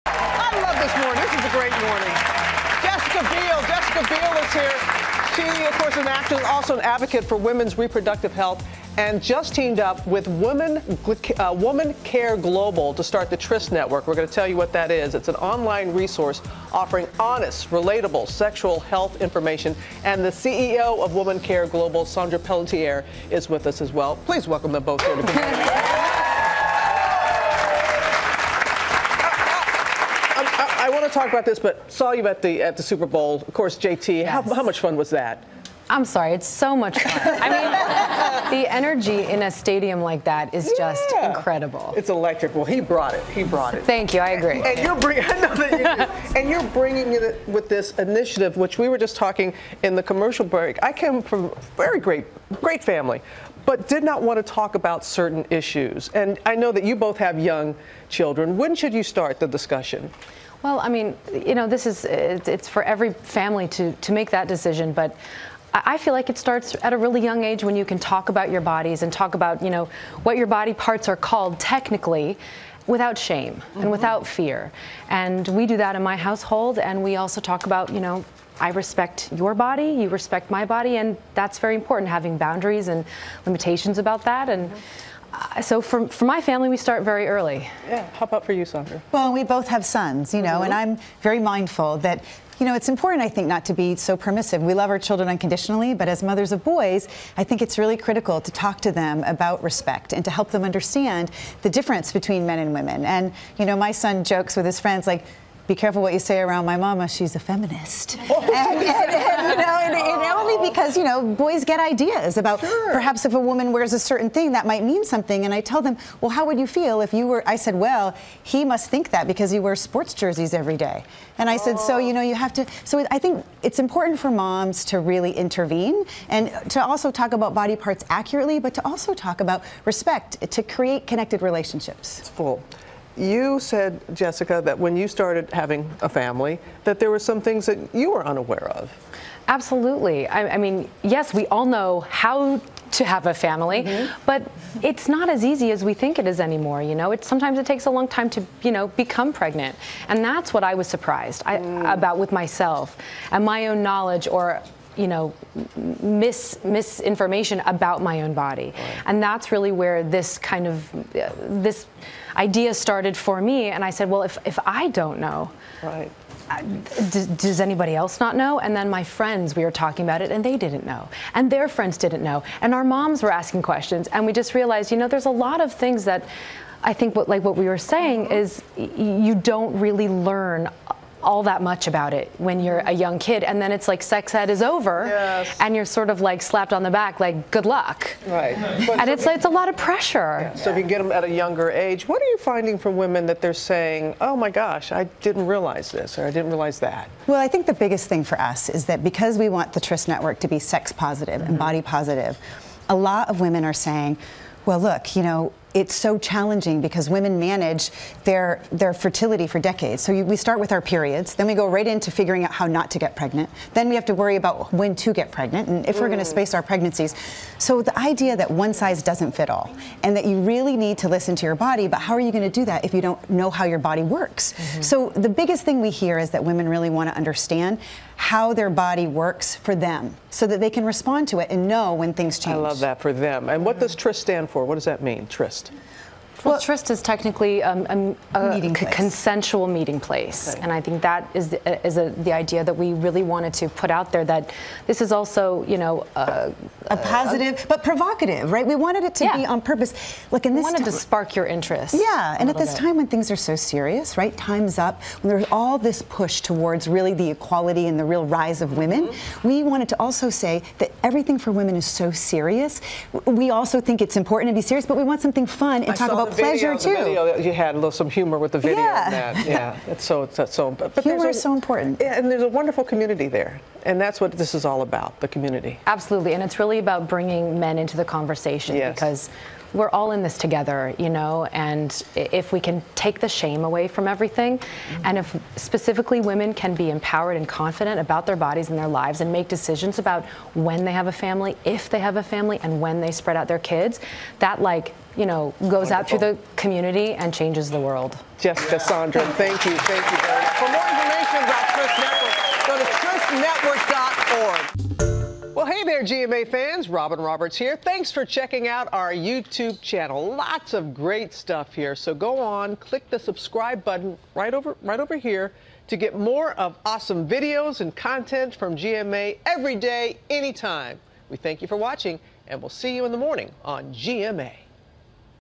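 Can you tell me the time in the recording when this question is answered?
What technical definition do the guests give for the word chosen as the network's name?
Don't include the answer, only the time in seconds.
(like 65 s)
238 s.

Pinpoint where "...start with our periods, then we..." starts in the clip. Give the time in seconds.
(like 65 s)
210 s.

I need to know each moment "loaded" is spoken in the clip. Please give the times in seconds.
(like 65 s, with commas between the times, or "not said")
not said.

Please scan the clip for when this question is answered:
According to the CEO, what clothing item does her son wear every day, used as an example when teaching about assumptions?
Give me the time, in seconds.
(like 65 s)
119 s.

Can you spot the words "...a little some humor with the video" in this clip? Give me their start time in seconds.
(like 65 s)
267 s.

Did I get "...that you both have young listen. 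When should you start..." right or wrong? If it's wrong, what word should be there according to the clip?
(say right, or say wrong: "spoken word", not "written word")
wrong: "children", not "listen".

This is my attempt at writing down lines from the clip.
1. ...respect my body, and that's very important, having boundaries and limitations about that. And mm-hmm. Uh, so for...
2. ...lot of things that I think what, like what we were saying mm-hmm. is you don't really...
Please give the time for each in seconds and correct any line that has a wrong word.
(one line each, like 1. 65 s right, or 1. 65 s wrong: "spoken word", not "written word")
1. 80 s right
2. 175 s right.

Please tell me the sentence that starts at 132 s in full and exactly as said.
It's full you said, Jessica, that when you started having a family, that there were some things that you were unaware of.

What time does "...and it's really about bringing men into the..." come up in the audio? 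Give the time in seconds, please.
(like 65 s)
276 s.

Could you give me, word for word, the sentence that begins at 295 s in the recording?
out through the community and changes the world.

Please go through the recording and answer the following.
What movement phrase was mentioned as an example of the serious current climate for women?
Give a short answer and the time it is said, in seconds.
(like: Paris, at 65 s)
Time's up, at 254 s.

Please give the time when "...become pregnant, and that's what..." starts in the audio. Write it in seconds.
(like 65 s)
148 s.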